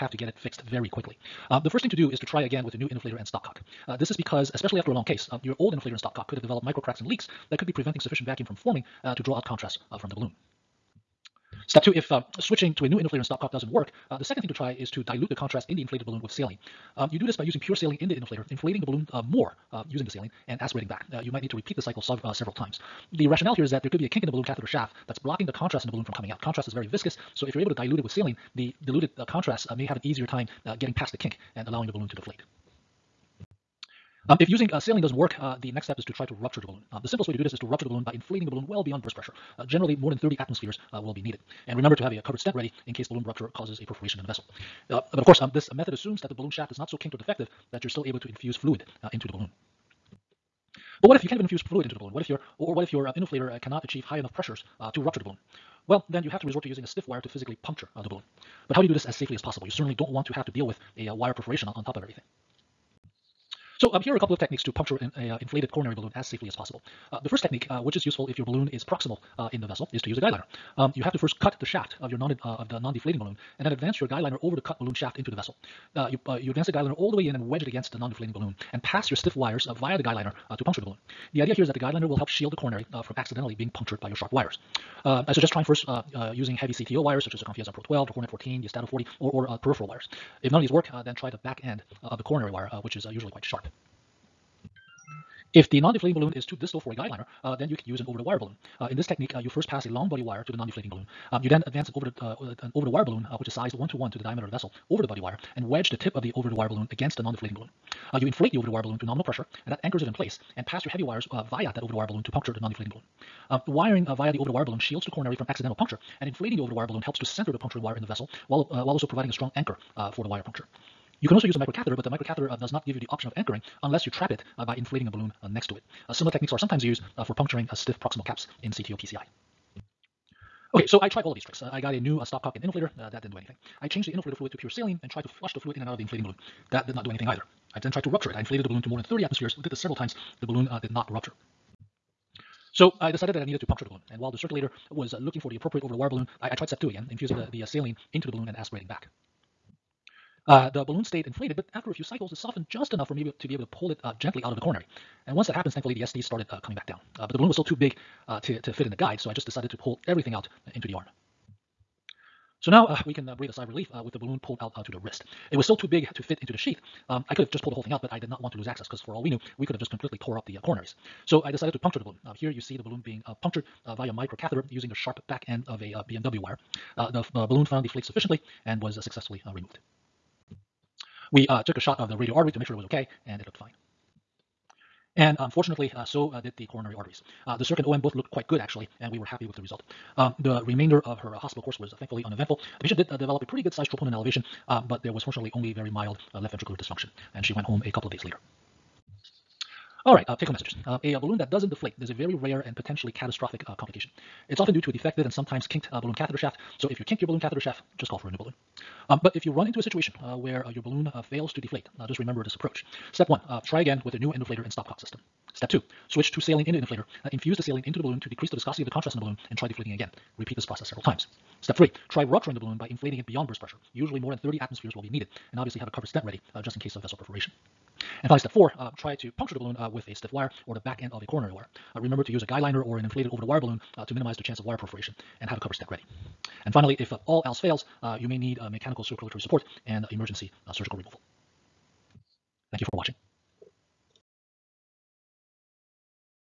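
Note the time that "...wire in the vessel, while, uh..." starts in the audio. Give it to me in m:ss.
1:57.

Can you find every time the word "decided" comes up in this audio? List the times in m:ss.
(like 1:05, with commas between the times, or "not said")
2:23, 2:39, 2:51.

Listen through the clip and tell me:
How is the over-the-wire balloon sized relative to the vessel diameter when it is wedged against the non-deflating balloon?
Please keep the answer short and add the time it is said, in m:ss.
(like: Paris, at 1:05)
1 to 1, at 1:43.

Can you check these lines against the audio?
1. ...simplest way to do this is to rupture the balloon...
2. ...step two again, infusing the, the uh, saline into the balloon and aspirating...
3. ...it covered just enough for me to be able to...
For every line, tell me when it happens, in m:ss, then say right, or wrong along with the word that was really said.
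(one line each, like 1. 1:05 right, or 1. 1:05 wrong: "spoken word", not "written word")
1. 0:37 right
2. 2:26 right
3. 2:32 wrong: "softened", not "covered".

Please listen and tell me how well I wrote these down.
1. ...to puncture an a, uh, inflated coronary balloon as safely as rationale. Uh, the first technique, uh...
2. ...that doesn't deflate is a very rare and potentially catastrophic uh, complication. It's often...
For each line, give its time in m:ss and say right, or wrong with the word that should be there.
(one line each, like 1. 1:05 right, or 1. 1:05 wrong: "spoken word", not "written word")
1. 1:04 wrong: "possible", not "rationale"
2. 3:21 right.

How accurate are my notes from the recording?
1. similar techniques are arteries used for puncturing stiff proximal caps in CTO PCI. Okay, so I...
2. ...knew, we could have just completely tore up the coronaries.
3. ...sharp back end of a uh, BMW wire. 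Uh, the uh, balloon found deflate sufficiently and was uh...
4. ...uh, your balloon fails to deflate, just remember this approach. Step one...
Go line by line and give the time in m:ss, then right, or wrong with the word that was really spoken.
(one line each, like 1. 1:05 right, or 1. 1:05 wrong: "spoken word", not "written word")
1. 2:06 wrong: "sometimes", not "arteries"
2. 2:49 right
3. 2:54 right
4. 3:30 right.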